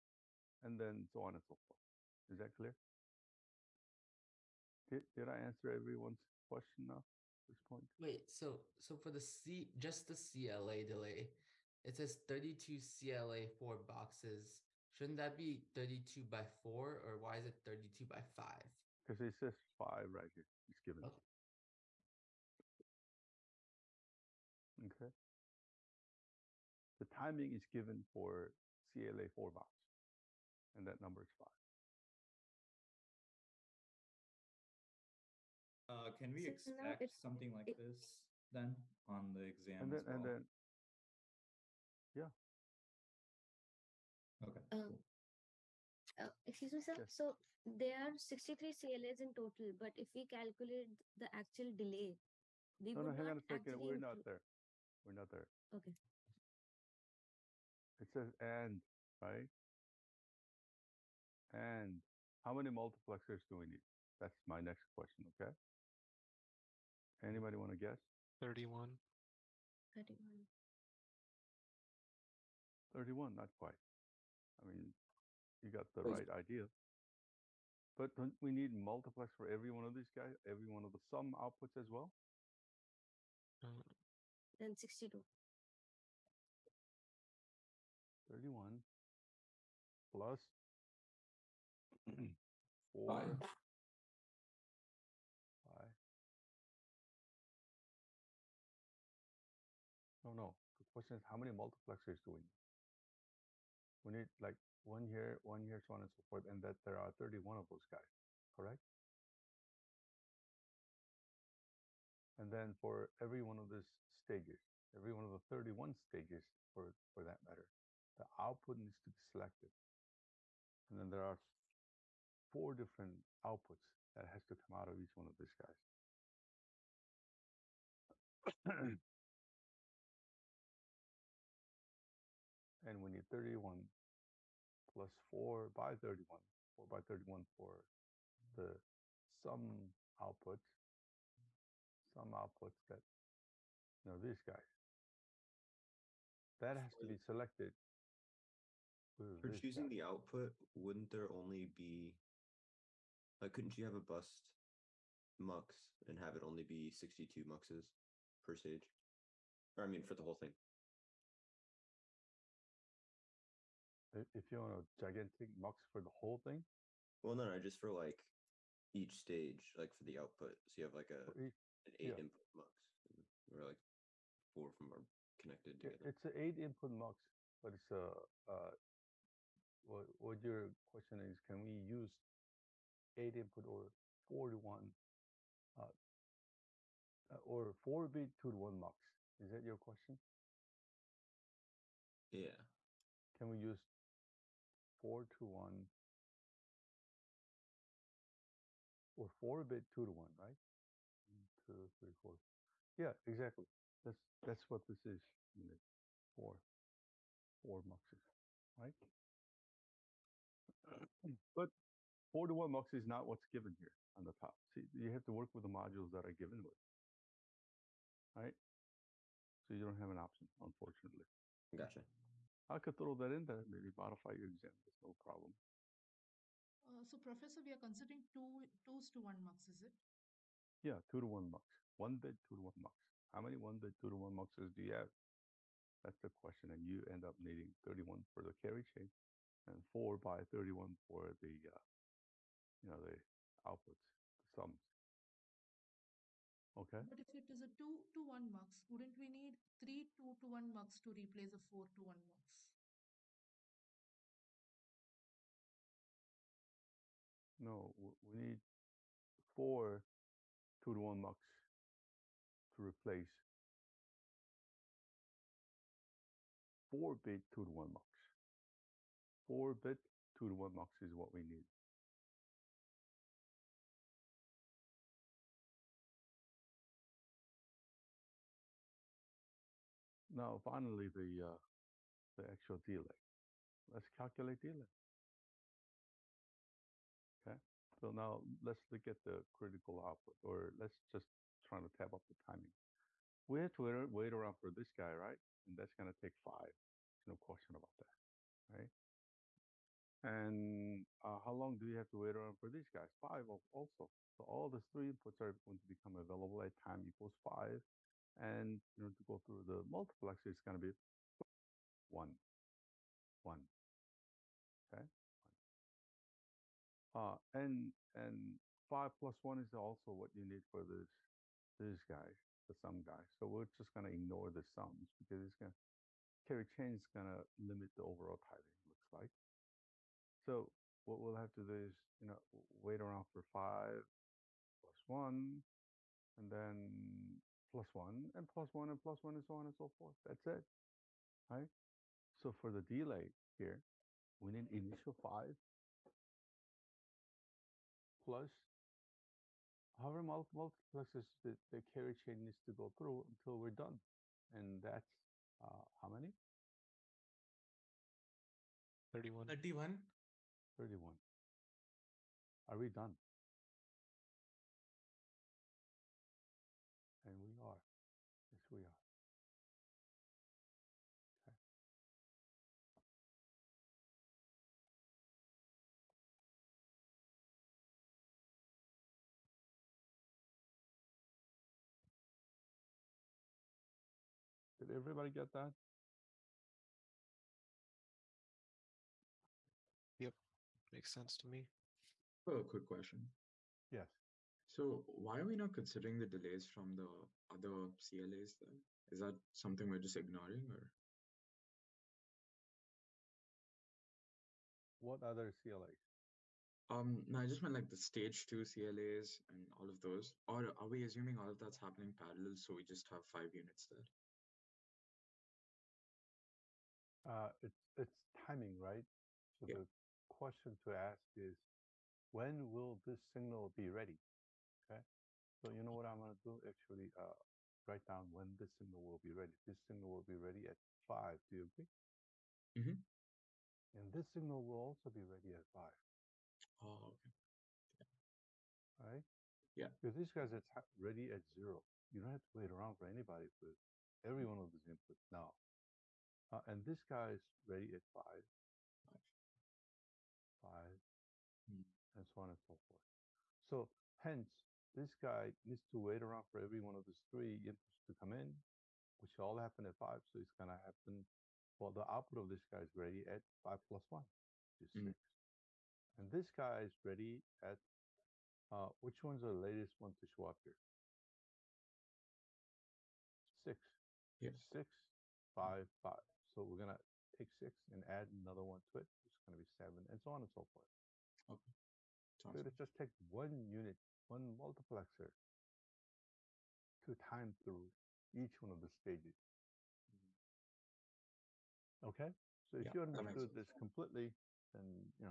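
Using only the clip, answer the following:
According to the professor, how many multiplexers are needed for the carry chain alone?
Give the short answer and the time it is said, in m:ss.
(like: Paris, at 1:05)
31, at 2:13.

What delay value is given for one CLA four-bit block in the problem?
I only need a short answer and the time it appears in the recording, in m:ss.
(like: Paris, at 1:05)
5, at 0:30.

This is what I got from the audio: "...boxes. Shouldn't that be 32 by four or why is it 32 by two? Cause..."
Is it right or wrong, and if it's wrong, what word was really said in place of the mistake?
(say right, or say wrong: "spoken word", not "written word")
wrong: "five", not "two".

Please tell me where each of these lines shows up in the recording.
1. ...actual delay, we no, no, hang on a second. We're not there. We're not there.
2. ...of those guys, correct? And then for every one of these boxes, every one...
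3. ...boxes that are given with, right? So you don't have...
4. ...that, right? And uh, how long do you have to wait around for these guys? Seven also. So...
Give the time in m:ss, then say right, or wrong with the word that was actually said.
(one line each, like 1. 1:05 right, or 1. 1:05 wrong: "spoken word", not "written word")
1. 0:51 right
2. 1:47 wrong: "stages", not "boxes"
3. 3:35 wrong: "modules", not "boxes"
4. 4:58 wrong: "Five", not "Seven".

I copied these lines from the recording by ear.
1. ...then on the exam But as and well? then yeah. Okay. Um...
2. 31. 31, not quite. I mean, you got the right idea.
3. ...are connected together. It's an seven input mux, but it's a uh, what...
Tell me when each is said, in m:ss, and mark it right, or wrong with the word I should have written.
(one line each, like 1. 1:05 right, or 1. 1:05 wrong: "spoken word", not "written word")
1. 0:38 wrong: "And", not "But"
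2. 1:09 right
3. 2:54 wrong: "eight", not "seven".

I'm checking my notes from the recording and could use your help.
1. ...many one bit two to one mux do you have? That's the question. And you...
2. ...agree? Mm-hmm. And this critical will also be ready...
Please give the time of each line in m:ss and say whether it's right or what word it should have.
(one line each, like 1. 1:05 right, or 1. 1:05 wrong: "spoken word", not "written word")
1. 3:53 right
2. 7:11 wrong: "signal", not "critical".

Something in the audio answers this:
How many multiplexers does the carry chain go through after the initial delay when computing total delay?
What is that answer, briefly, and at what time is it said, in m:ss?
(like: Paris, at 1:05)
31, at 5:59.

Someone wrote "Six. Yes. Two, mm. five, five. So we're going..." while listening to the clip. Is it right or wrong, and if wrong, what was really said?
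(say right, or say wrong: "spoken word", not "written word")
wrong: "Six", not "Two".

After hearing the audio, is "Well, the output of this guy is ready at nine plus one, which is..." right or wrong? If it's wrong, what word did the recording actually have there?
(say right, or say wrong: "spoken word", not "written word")
wrong: "five", not "nine".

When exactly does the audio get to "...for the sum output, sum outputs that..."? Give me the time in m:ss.
2:17.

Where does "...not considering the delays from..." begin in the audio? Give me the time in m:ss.
6:35.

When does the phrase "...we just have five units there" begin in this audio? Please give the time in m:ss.
6:52.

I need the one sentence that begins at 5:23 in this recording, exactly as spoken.
So we're just going to ignore the sums because it's going to, carry chain is going to limit the overall timing.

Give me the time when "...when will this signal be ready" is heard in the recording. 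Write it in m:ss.
7:02.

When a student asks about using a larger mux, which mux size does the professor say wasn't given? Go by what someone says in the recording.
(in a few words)
four to one mux.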